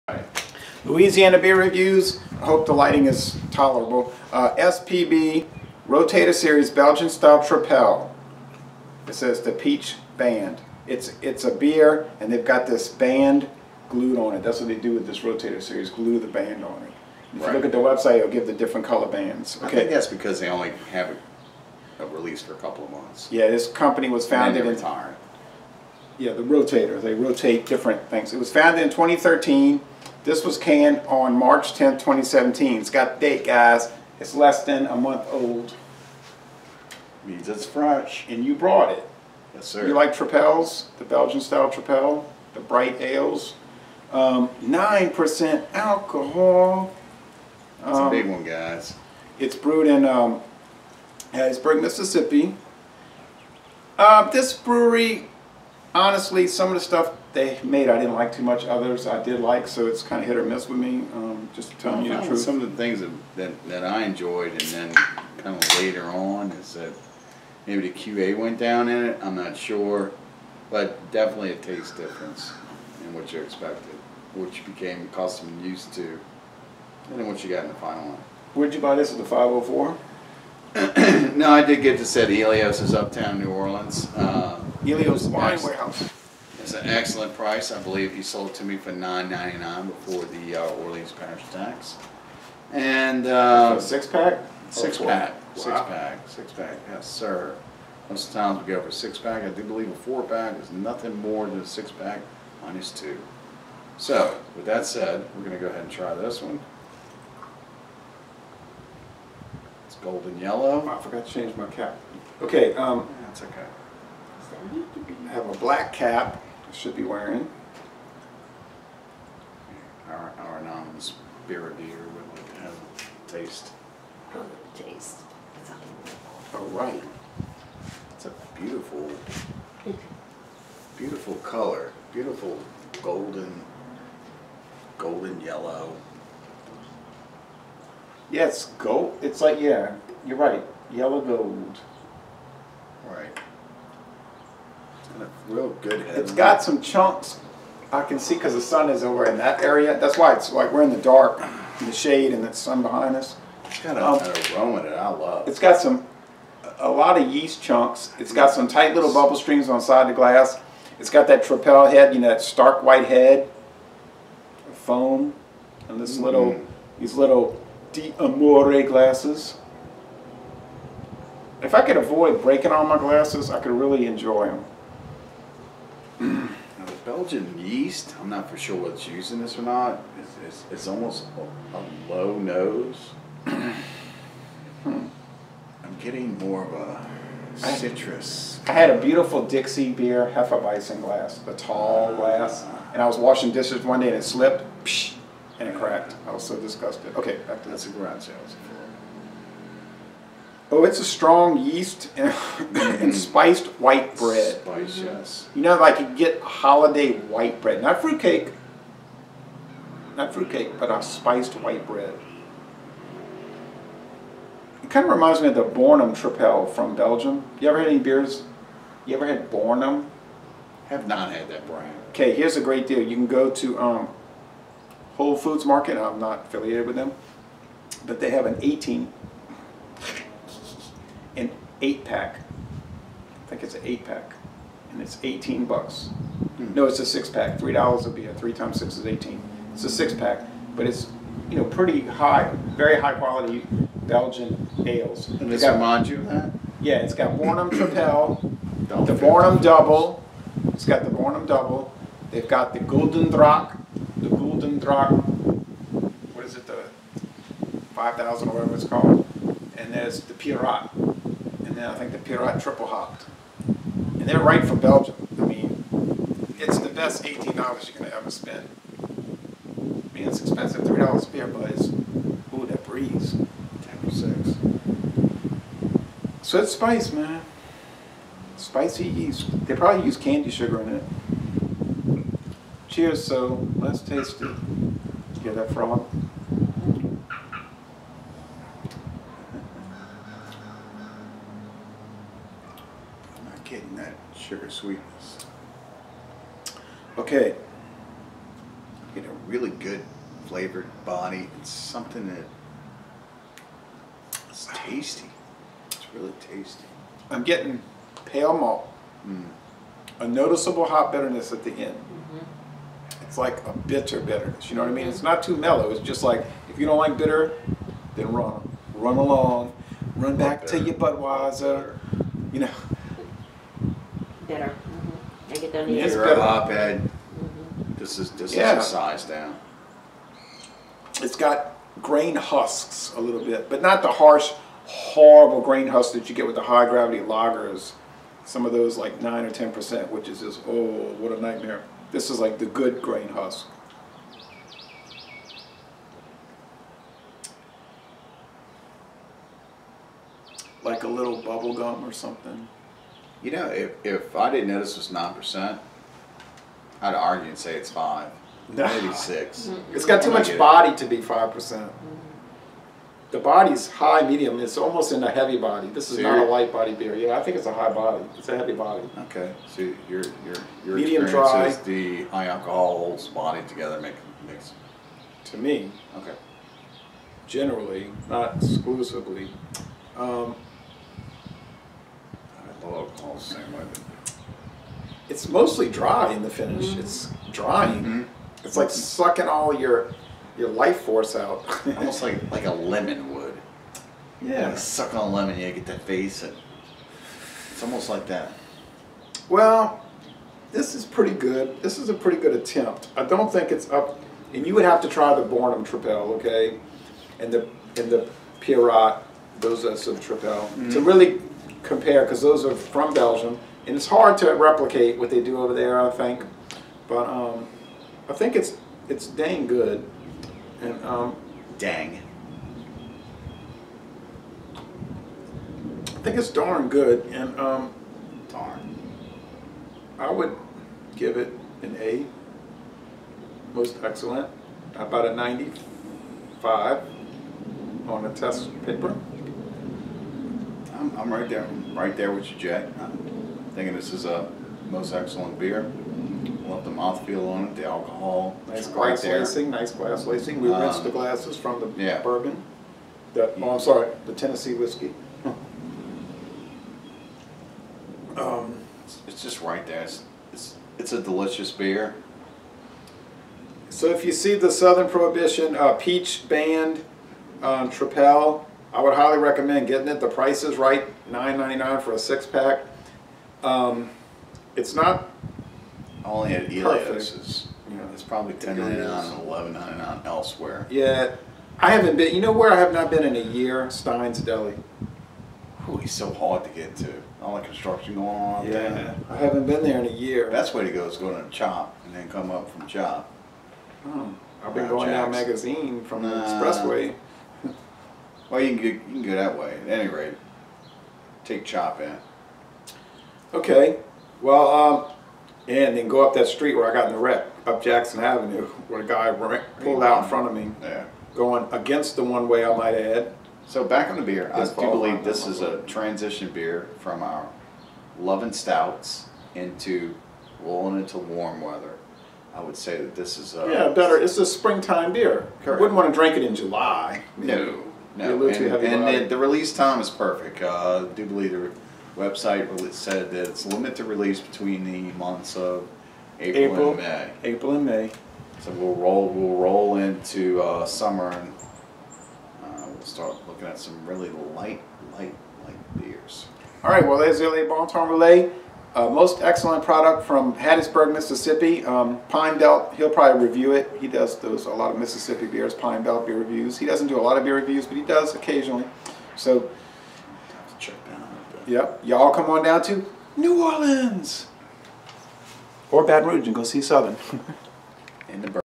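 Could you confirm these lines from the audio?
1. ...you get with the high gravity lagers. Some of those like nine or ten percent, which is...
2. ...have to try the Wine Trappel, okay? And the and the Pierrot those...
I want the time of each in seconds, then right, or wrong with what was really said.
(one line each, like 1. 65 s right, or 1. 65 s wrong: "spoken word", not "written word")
1. 336 s right
2. 404 s wrong: "Bornem", not "Wine".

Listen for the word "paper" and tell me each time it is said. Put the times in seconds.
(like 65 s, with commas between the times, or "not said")
438 s.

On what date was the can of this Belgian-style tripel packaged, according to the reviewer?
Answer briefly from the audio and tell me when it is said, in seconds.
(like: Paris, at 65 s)
March 10th, 2017, at 31 s.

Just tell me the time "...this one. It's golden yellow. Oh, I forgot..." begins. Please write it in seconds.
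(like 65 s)
106 s.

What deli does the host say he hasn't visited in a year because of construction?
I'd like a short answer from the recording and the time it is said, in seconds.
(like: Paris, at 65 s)
Stein's Deli, at 483 s.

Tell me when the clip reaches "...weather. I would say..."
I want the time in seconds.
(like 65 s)
521 s.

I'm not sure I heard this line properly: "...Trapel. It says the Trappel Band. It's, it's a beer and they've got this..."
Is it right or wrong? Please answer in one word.
wrong.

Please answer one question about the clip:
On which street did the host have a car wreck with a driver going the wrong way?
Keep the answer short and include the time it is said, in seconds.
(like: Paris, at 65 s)
Jackson Avenue, at 507 s.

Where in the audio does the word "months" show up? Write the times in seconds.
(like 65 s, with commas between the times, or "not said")
22 s, 34 s, 535 s.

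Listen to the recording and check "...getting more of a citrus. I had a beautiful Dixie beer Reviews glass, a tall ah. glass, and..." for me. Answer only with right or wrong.
wrong.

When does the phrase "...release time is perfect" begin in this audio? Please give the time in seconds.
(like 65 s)
529 s.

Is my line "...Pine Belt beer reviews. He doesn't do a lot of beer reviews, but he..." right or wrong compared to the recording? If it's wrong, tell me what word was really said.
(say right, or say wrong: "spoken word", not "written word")
right.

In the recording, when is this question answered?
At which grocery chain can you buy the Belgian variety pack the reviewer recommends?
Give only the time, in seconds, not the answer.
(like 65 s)
225 s.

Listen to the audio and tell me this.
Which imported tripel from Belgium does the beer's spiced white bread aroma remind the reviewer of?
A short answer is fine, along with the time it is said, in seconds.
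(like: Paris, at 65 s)
Bornem Tripel, at 215 s.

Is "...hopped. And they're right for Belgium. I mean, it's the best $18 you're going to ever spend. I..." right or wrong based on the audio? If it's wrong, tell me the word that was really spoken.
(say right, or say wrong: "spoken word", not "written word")
right.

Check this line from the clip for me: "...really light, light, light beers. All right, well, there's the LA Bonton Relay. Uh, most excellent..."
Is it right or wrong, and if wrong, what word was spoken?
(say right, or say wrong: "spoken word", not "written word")
right.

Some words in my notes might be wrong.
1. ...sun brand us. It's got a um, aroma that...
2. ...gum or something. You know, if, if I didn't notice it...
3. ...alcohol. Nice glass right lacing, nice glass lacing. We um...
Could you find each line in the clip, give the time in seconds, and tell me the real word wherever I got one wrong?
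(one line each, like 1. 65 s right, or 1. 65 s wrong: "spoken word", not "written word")
1. 152 s wrong: "behind", not "brand"
2. 351 s right
3. 447 s right.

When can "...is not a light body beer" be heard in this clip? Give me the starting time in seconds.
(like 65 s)
366 s.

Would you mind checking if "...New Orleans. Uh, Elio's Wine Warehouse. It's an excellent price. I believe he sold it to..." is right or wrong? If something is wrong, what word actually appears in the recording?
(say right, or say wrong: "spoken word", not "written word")
right.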